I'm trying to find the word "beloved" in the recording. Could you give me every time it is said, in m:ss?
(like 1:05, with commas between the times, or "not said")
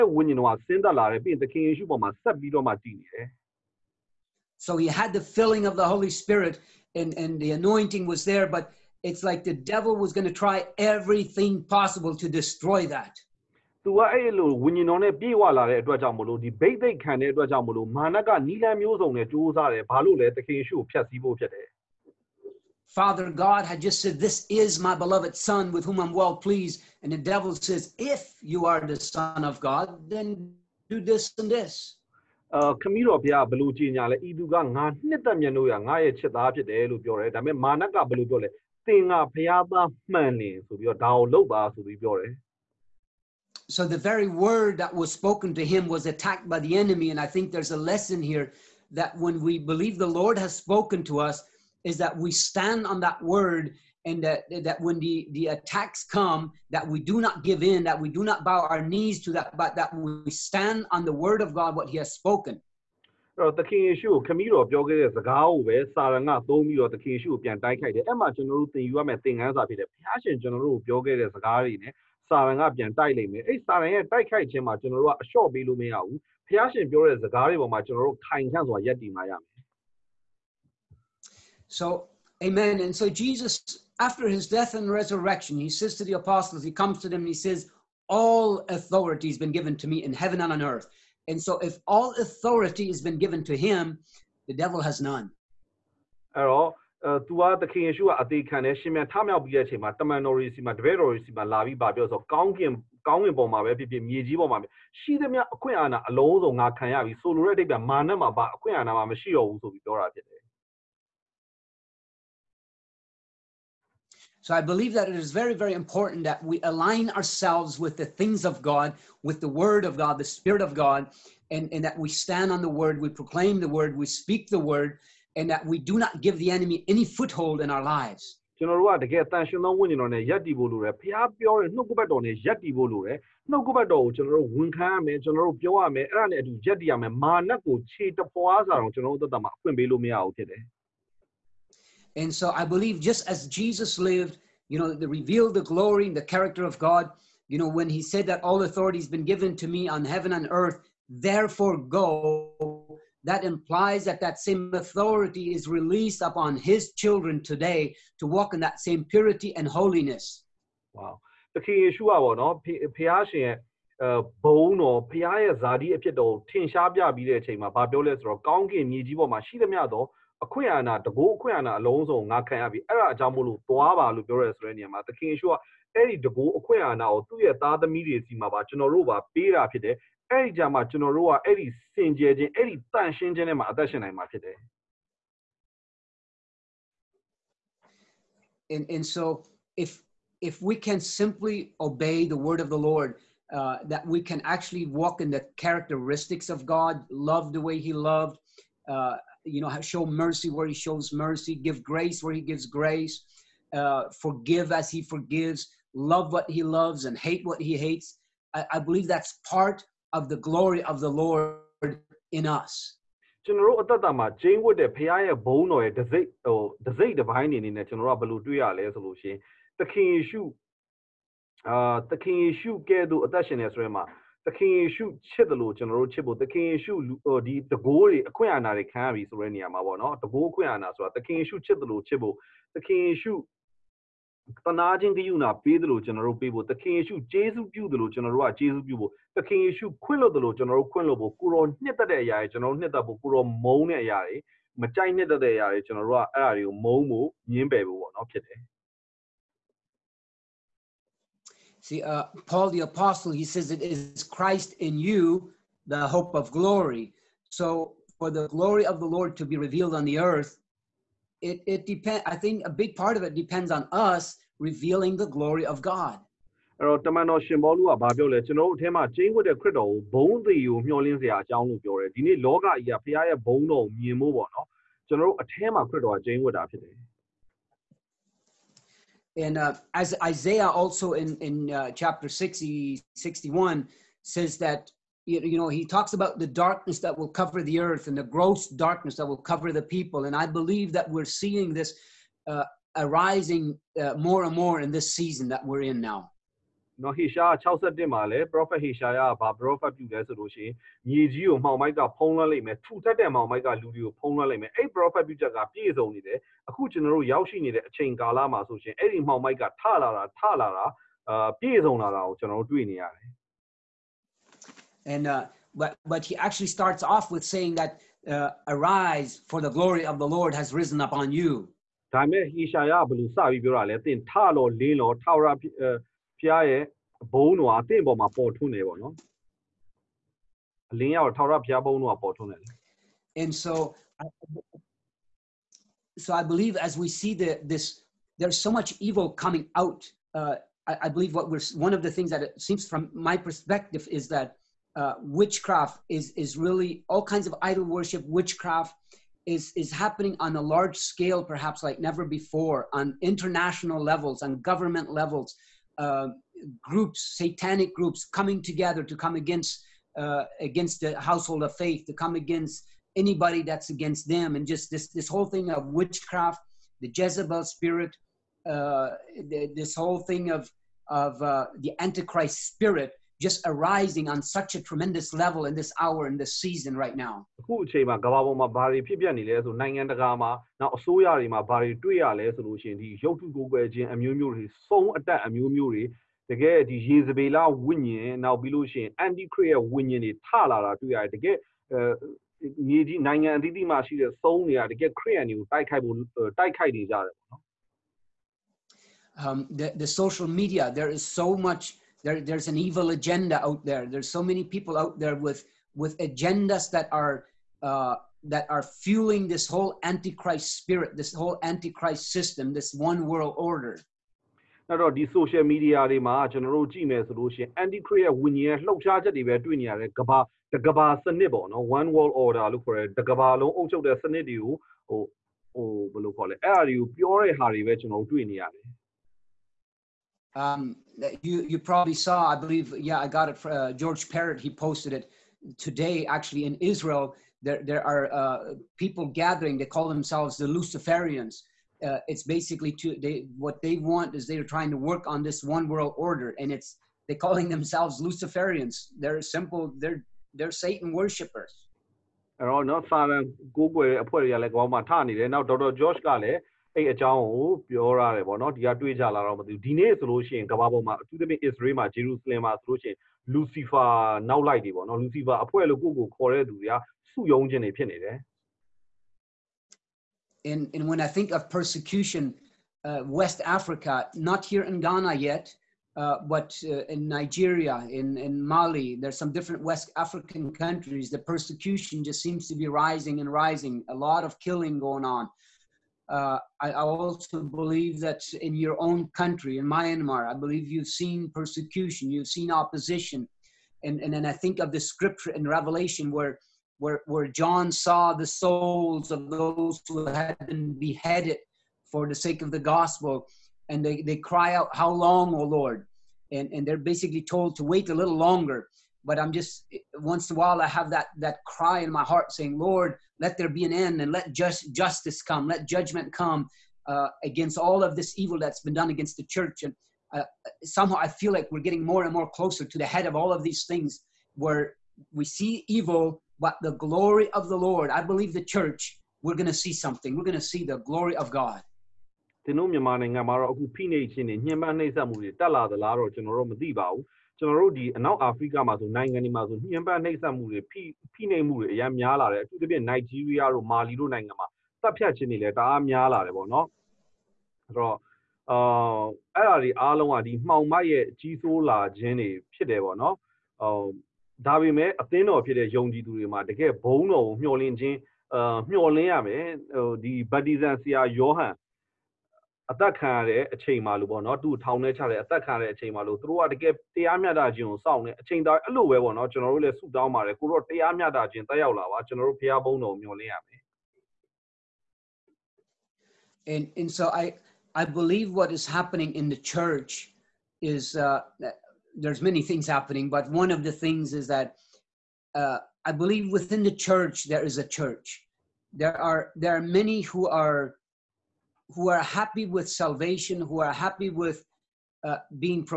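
0:24.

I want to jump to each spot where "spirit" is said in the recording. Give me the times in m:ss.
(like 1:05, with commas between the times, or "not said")
2:00, 6:07, 6:12, 6:50.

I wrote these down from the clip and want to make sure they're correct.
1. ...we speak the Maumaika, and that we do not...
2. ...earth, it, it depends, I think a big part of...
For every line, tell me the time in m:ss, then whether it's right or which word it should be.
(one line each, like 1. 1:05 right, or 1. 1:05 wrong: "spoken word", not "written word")
1. 2:03 wrong: "Word", not "Maumaika"
2. 4:20 right.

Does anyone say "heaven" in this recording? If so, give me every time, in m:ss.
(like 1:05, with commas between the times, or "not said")
1:30, 2:30.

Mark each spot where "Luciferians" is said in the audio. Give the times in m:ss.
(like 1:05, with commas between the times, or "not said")
7:20, 7:28.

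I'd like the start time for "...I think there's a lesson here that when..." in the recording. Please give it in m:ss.
0:47.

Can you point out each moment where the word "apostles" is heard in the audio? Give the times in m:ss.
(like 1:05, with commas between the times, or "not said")
1:26, 4:12.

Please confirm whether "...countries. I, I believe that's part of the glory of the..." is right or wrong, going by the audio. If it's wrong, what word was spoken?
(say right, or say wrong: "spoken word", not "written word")
wrong: "hates", not "countries".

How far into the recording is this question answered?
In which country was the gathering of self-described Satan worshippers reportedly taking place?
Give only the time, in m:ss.
7:16.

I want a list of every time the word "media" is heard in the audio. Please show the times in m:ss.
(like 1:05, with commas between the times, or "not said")
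6:40, 6:55.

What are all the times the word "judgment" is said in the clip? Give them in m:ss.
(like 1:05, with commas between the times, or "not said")
8:35.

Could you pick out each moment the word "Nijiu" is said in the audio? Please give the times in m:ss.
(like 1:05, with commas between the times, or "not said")
5:01.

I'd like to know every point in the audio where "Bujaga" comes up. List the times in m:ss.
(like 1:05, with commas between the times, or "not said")
5:05.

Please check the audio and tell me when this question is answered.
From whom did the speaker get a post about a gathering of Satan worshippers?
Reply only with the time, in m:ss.
7:13.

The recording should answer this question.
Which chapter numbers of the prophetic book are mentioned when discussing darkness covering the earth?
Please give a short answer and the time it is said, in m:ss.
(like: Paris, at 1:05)
60, 61, at 4:41.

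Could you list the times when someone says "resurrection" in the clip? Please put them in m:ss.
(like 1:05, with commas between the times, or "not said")
1:24.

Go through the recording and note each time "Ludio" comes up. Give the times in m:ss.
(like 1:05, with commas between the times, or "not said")
5:03.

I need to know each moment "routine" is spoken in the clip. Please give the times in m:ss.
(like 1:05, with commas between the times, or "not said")
not said.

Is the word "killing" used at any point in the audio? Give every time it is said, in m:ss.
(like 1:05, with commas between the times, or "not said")
8:04.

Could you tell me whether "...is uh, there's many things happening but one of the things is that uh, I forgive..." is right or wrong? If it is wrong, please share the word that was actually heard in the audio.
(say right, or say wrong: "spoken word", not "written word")
wrong: "believe", not "forgive".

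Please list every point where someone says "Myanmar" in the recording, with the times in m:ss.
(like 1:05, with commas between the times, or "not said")
8:09.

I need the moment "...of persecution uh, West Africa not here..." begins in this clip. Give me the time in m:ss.
7:51.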